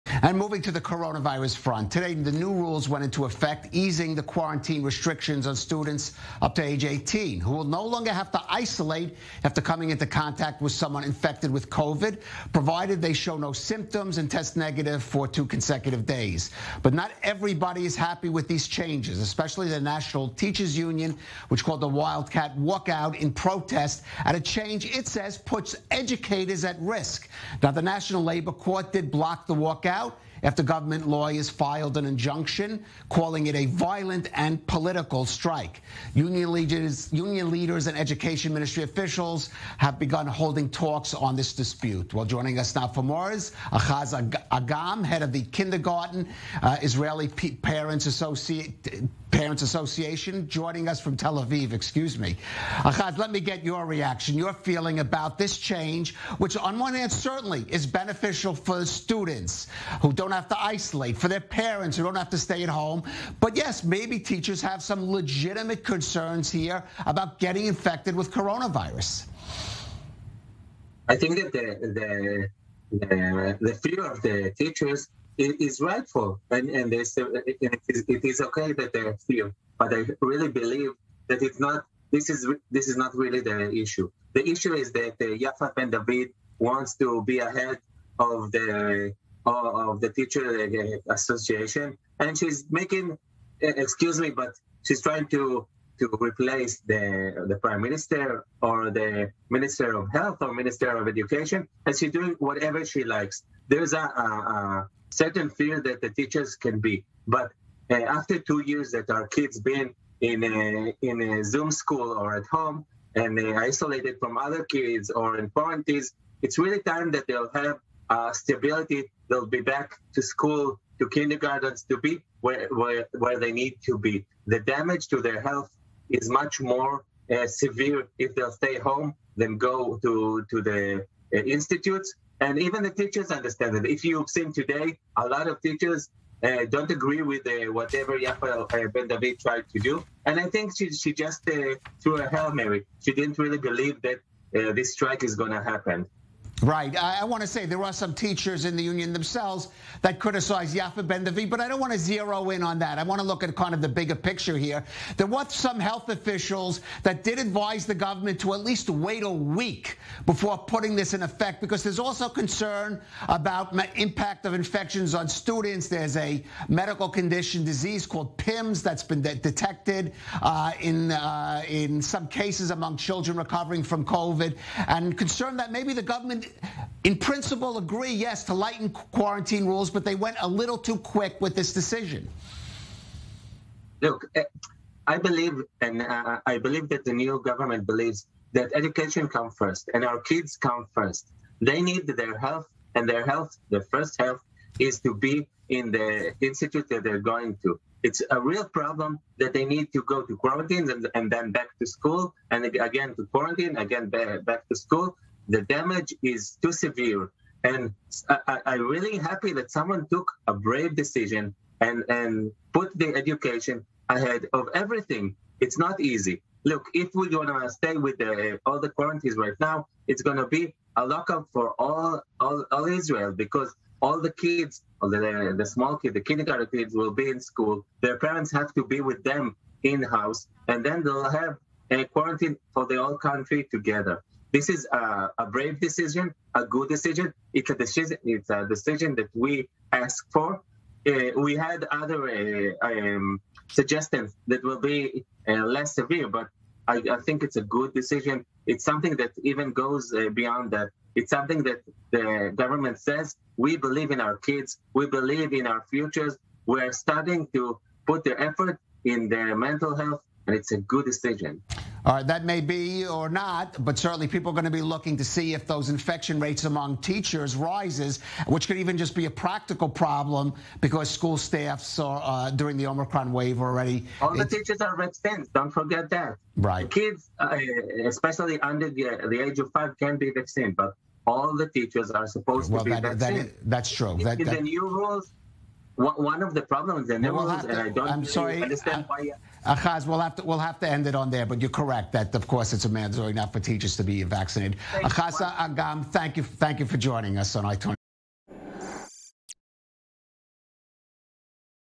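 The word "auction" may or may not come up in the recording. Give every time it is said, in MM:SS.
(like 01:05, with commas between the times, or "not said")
not said.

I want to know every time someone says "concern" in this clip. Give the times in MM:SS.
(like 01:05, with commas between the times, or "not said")
01:05, 02:42, 02:55.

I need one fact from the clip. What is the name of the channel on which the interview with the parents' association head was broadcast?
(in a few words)
i24.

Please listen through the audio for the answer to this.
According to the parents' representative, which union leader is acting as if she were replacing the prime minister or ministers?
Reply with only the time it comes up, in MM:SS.
02:18.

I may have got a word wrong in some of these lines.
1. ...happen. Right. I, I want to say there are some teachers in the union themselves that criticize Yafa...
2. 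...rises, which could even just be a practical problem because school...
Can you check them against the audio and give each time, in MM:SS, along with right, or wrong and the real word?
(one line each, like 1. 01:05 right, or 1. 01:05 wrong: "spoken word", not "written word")
1. 02:25 right
2. 04:27 right.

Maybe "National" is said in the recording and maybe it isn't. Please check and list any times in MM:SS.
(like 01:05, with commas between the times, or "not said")
00:19, 00:27.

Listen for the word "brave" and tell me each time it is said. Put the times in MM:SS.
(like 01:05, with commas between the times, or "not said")
03:30, 03:55.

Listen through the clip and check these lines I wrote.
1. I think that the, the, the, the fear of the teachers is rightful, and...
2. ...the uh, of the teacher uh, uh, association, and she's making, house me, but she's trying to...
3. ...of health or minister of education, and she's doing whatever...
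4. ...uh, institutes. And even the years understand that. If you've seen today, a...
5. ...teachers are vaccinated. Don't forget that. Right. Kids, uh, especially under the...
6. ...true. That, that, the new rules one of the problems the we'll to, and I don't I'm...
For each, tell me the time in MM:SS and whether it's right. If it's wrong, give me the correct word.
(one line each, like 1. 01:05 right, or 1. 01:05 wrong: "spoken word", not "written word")
1. 01:11 right
2. 01:28 wrong: "excuse", not "house"
3. 01:39 right
4. 02:11 wrong: "teachers", not "years"
5. 04:34 right
6. 04:43 right.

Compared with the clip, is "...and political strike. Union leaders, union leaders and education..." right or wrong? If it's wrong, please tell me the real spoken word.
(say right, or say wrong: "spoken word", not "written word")
right.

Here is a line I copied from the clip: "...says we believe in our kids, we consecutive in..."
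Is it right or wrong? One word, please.
wrong.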